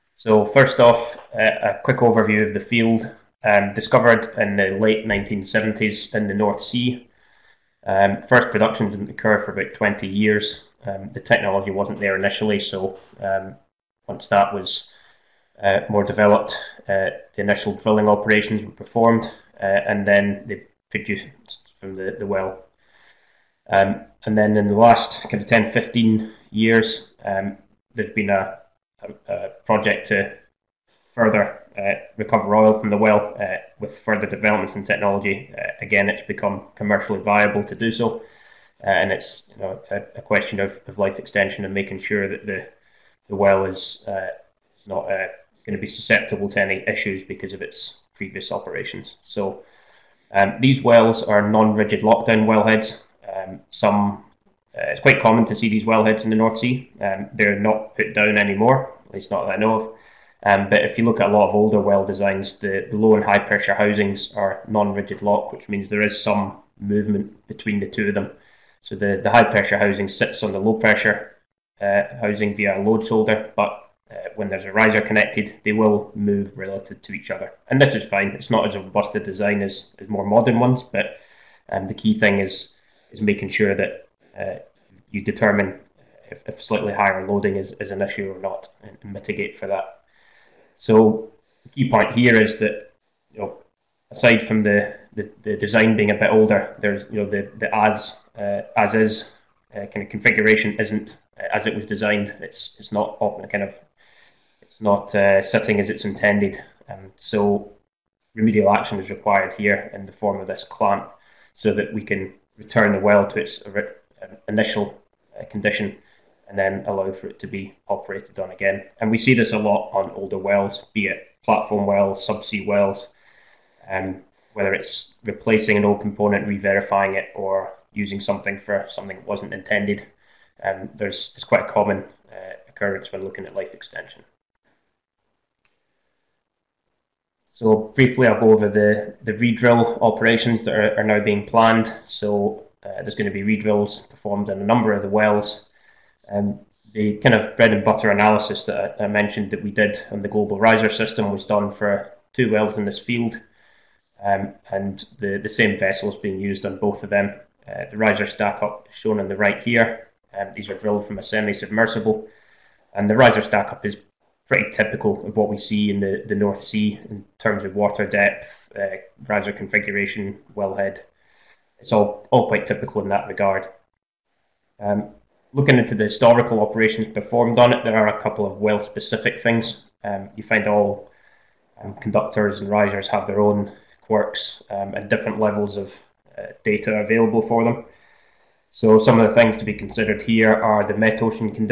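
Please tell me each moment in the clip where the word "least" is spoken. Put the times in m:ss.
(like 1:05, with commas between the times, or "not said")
0:59.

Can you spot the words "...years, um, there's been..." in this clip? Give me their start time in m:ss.
0:26.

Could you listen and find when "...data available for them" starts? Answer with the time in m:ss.
3:06.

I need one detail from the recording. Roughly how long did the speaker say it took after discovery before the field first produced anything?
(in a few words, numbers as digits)
20 years.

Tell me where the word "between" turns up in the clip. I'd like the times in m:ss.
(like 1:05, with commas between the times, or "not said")
1:07.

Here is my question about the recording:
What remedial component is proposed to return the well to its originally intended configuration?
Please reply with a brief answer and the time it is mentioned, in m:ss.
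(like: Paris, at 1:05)
Clamp, at 1:50.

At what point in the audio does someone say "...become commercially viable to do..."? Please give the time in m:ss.
0:36.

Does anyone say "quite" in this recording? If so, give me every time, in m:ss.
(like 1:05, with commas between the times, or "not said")
0:54, 2:11, 2:52.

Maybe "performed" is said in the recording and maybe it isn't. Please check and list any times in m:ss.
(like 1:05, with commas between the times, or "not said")
0:18, 2:24, 2:57.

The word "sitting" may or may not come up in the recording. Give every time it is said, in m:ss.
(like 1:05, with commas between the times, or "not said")
1:45.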